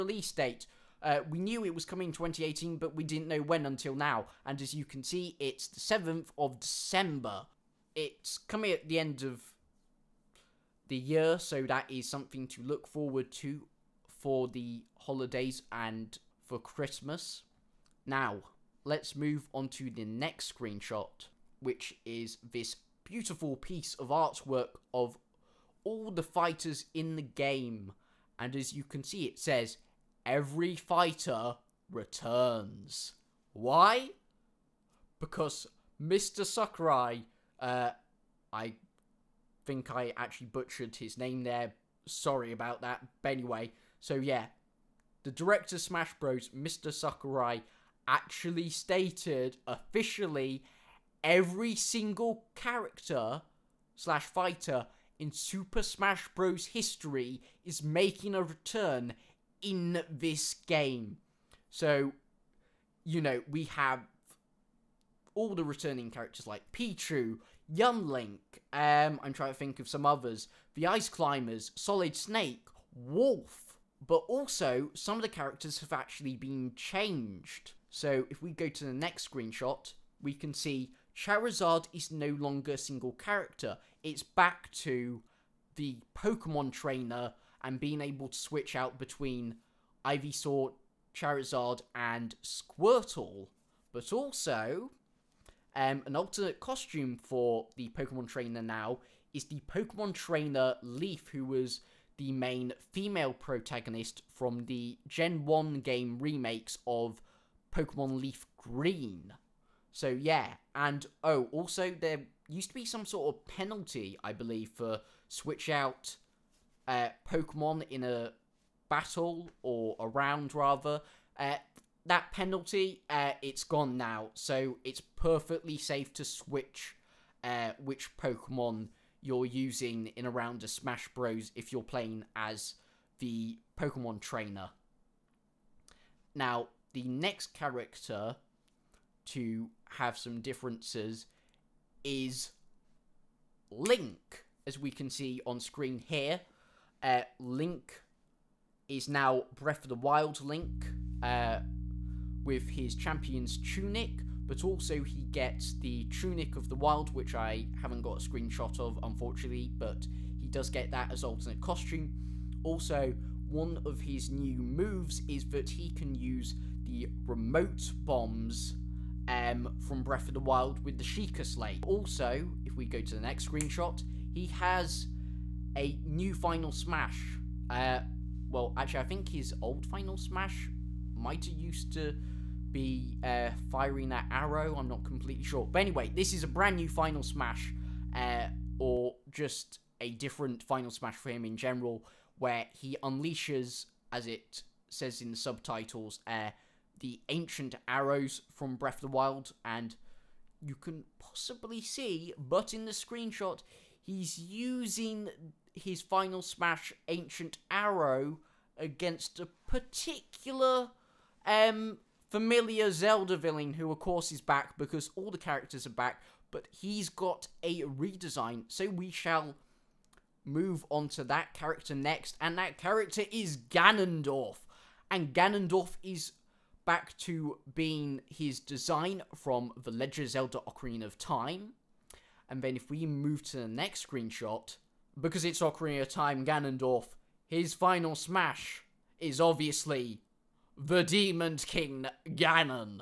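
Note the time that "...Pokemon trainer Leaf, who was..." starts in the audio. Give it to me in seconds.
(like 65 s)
99 s.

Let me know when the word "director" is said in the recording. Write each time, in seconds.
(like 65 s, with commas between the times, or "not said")
45 s.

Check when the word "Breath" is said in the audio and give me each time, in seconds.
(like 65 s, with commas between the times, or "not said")
149 s, 170 s, 198 s.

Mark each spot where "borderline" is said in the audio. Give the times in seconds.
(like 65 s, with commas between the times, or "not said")
not said.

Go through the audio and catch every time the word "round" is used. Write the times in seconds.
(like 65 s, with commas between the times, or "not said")
120 s, 130 s.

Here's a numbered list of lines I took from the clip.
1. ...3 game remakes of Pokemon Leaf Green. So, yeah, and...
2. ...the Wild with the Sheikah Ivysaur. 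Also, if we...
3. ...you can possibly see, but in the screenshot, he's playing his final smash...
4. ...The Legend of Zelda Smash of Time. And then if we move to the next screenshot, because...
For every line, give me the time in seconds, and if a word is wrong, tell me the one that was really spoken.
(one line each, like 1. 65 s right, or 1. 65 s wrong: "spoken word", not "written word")
1. 105 s wrong: "1", not "3"
2. 170 s wrong: "Slate", not "Ivysaur"
3. 200 s wrong: "using", not "playing"
4. 229 s wrong: "Ocarina", not "Smash".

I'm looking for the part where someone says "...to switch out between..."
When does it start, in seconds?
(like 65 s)
88 s.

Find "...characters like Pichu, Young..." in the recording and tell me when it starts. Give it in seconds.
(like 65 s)
66 s.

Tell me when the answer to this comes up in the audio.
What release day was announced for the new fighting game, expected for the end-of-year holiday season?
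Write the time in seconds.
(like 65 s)
5 s.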